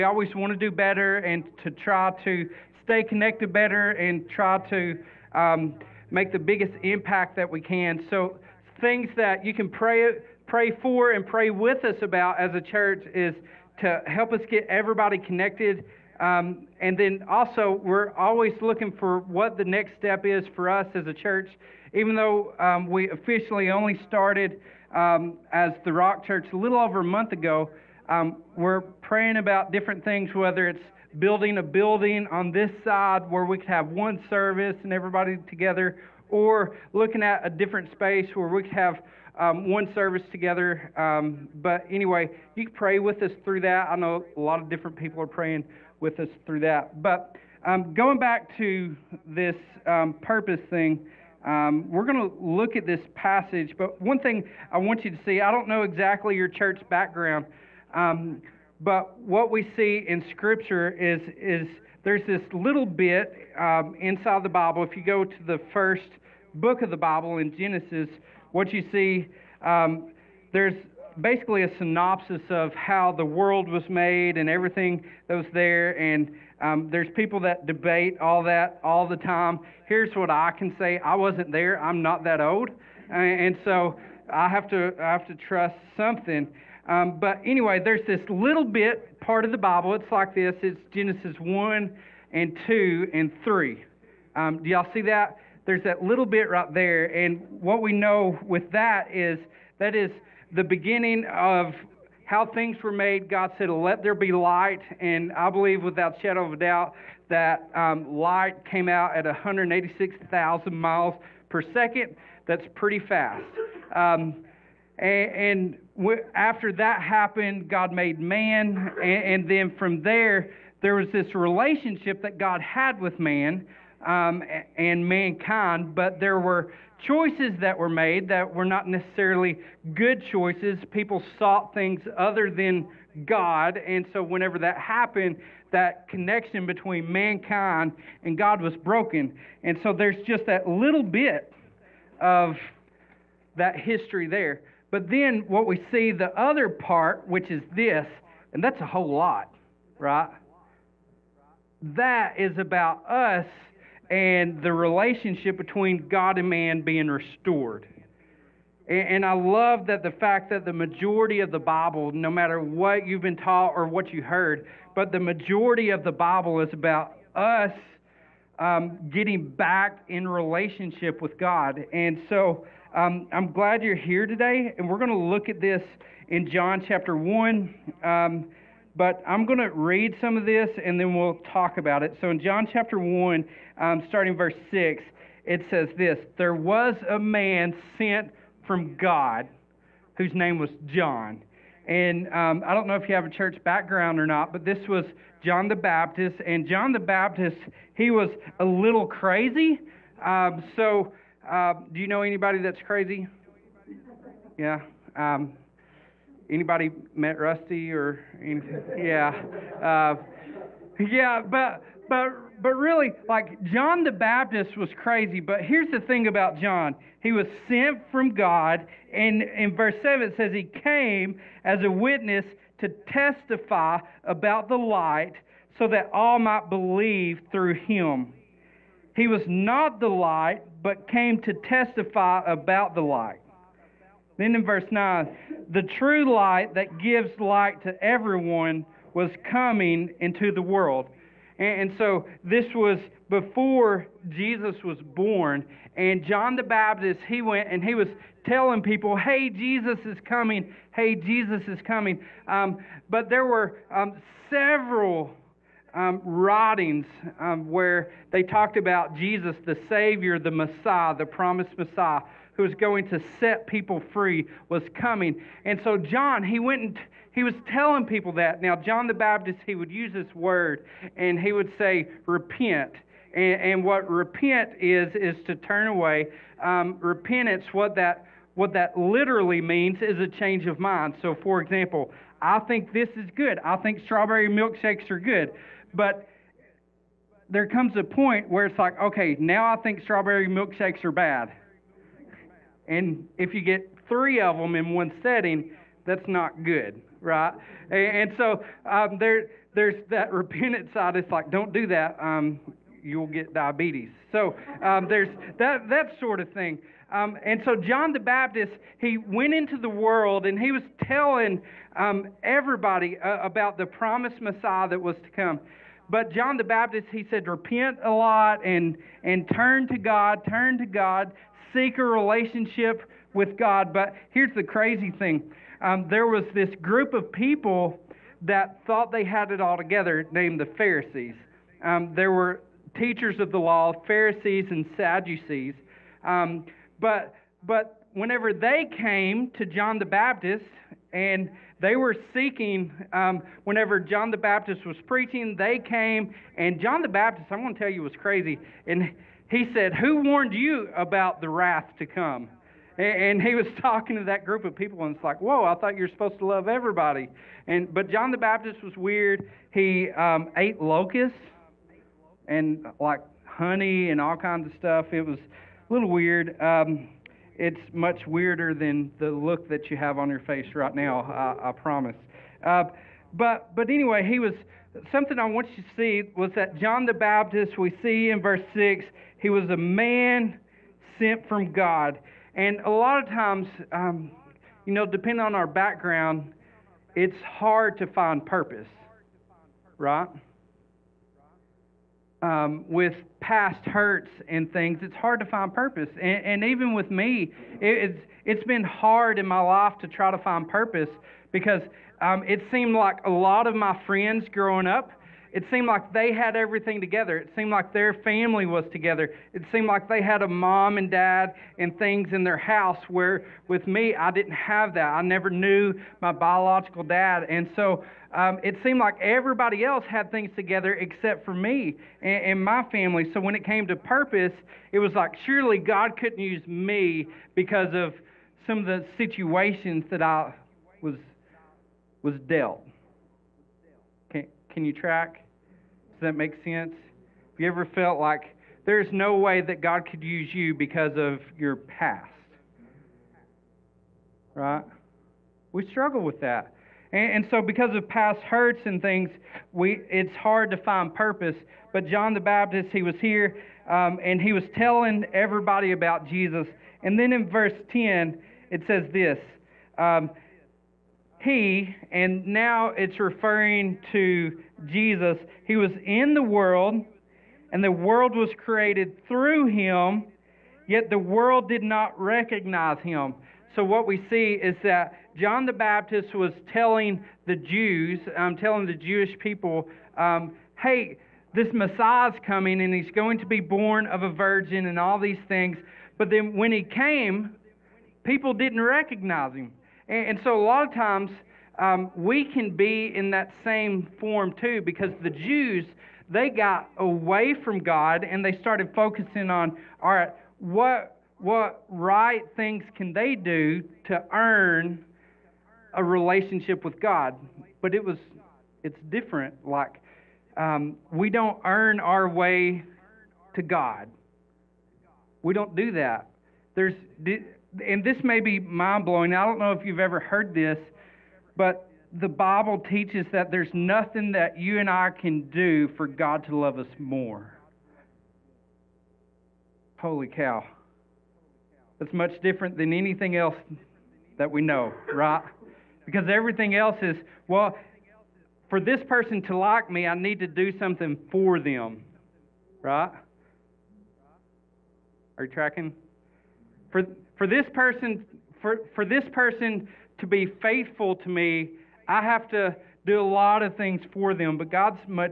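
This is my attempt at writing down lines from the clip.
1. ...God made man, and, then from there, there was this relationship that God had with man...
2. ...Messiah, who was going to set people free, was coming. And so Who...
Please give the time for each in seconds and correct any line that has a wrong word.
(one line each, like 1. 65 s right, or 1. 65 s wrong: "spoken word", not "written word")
1. 117 s right
2. 261 s wrong: "John", not "Who".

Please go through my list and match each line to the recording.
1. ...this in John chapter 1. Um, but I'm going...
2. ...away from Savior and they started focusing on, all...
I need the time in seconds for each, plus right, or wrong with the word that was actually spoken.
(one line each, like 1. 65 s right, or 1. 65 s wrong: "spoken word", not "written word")
1. 175 s right
2. 496 s wrong: "God", not "Savior".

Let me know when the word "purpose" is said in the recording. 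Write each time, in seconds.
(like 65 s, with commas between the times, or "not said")
50 s, 388 s, 395 s, 400 s, 423 s, 451 s.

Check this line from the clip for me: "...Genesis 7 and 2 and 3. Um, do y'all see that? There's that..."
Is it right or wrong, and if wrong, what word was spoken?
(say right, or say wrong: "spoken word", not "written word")
wrong: "1", not "7".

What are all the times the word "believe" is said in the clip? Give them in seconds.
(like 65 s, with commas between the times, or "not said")
105 s, 226 s.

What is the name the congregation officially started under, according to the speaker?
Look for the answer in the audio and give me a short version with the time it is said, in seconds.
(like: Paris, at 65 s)
the Rock Church, at 25 s.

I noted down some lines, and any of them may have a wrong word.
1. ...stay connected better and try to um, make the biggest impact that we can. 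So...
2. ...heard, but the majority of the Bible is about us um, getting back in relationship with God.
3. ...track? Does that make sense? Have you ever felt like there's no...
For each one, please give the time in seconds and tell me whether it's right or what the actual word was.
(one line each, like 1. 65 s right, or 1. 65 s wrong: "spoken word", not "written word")
1. 2 s right
2. 164 s right
3. 434 s right.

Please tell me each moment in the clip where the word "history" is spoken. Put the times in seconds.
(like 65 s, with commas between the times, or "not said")
143 s.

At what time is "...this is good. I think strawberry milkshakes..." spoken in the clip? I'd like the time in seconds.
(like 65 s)
282 s.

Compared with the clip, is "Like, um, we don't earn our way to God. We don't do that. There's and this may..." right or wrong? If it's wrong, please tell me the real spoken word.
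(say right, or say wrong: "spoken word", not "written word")
right.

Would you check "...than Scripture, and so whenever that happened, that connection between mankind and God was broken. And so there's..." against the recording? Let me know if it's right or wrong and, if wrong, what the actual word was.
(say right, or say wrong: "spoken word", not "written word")
wrong: "God", not "Scripture".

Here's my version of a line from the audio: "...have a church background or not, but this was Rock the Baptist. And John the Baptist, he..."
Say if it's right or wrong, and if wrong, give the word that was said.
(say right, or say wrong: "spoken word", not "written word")
wrong: "John", not "Rock".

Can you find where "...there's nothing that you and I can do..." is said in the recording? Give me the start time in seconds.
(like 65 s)
523 s.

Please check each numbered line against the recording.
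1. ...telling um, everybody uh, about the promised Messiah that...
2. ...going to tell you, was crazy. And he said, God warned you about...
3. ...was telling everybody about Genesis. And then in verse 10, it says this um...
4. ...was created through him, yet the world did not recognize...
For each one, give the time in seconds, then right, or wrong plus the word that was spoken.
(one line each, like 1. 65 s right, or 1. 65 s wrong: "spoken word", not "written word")
1. 311 s right
2. 347 s wrong: "Who", not "God"
3. 454 s wrong: "Jesus", not "Genesis"
4. 468 s right.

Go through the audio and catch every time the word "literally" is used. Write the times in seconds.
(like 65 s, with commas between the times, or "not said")
278 s.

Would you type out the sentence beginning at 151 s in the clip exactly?
That is about us and the relationship between God and man being restored.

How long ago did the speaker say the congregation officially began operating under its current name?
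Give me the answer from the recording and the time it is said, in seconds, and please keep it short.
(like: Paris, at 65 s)
a little over a month ago, at 26 s.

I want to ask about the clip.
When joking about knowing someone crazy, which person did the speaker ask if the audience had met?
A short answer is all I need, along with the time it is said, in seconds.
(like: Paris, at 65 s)
Rusty, at 207 s.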